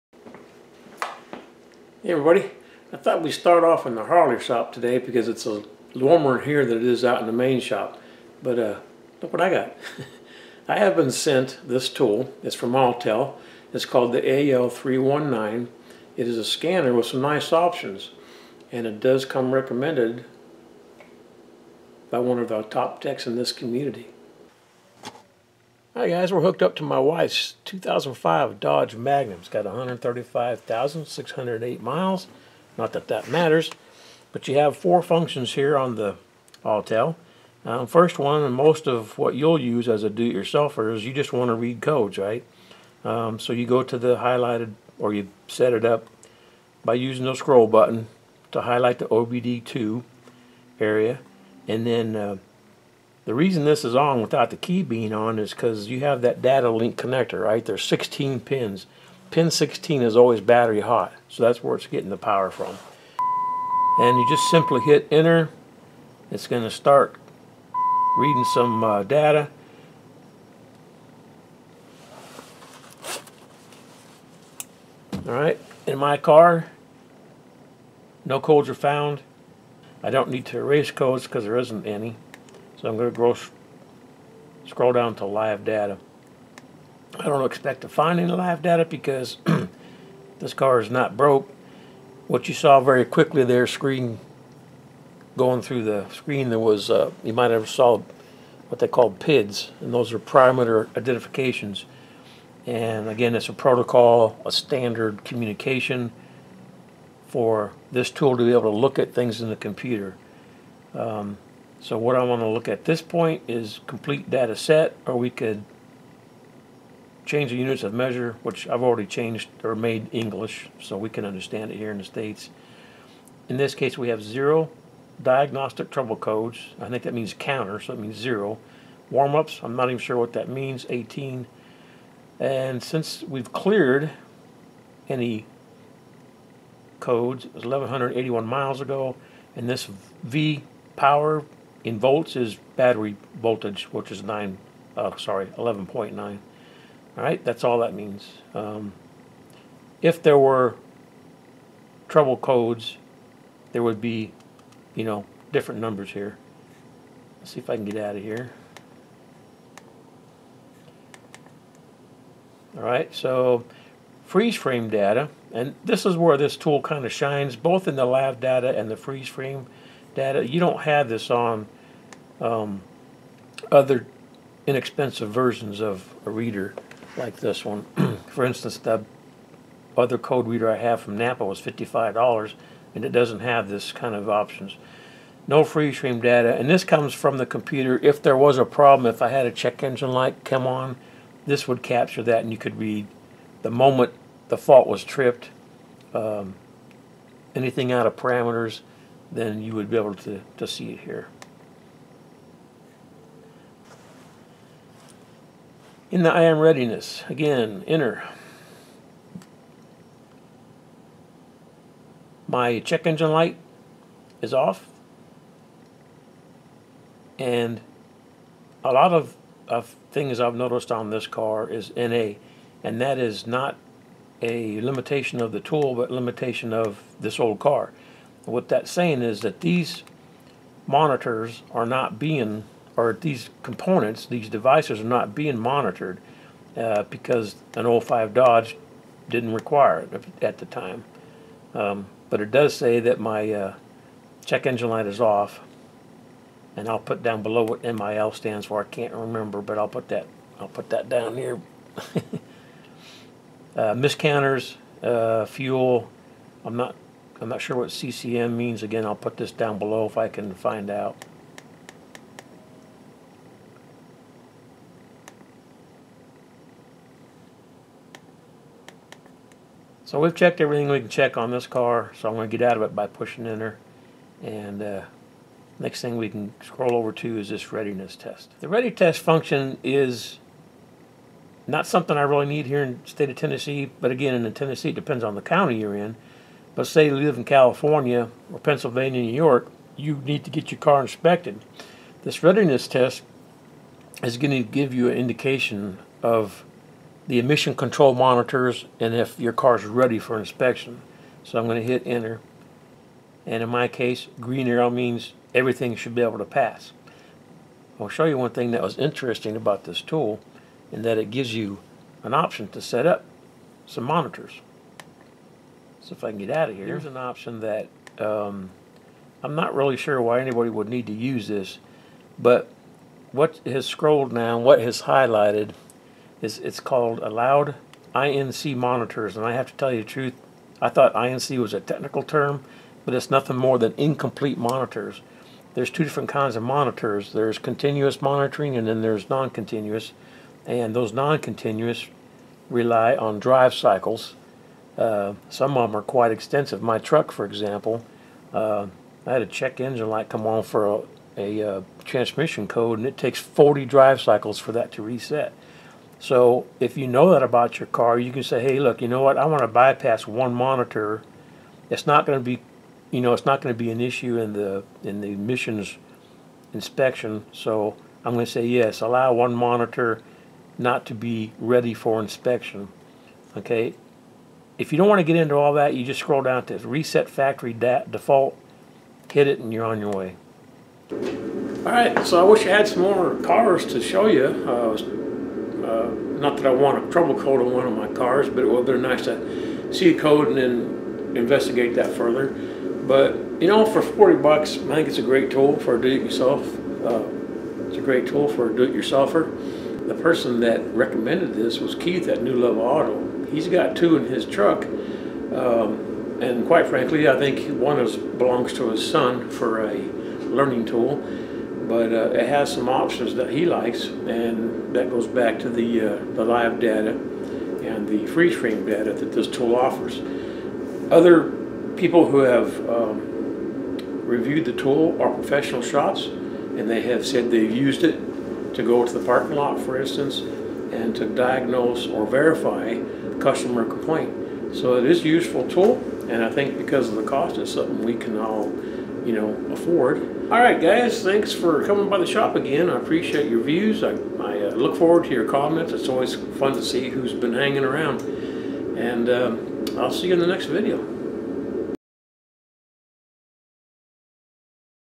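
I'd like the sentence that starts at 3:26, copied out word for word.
In the I/M readiness, again, enter.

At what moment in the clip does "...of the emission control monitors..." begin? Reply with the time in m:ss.
4:56.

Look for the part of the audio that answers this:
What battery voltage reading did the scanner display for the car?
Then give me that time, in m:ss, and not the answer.
2:25.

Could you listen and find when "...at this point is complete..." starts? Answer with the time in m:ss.
1:52.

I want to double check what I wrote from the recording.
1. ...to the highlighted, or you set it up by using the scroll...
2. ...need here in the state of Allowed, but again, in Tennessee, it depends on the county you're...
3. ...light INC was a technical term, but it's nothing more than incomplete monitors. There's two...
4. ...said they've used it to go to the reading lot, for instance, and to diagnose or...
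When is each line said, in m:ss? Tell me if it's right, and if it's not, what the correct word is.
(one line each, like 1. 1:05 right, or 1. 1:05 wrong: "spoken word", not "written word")
1. 0:43 right
2. 4:42 wrong: "Tennessee", not "Allowed"
3. 5:30 wrong: "thought", not "light"
4. 7:07 wrong: "parking", not "reading".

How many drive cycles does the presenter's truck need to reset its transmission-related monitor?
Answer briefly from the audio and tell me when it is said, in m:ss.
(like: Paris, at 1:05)
40, at 5:53.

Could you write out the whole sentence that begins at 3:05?
No free stream data, and this comes from the computer.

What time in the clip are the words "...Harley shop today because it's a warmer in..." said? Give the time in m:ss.
0:04.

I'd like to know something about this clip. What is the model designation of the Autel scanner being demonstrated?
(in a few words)
AL319.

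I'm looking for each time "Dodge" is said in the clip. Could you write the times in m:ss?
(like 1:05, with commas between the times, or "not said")
0:28, 3:58.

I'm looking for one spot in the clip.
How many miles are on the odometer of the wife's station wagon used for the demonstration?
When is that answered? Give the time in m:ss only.
0:29.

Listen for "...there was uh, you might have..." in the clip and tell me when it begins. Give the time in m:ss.
1:36.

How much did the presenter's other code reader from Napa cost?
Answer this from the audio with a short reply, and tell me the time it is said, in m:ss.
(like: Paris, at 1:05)
$55, at 3:01.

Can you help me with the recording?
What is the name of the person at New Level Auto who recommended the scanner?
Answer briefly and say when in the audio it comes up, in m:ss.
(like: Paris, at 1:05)
Keith, at 6:41.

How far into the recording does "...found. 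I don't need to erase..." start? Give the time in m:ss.
1:18.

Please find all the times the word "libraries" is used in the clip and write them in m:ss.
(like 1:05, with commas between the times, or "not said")
not said.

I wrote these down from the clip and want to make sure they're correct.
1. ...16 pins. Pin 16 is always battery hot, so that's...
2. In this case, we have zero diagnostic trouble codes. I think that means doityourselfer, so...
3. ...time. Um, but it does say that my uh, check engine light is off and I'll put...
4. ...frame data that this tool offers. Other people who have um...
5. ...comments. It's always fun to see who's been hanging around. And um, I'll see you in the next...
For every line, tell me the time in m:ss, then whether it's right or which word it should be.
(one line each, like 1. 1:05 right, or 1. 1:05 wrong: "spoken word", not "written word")
1. 0:57 right
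2. 2:03 wrong: "counter", not "doityourselfer"
3. 4:00 right
4. 6:58 right
5. 7:25 right.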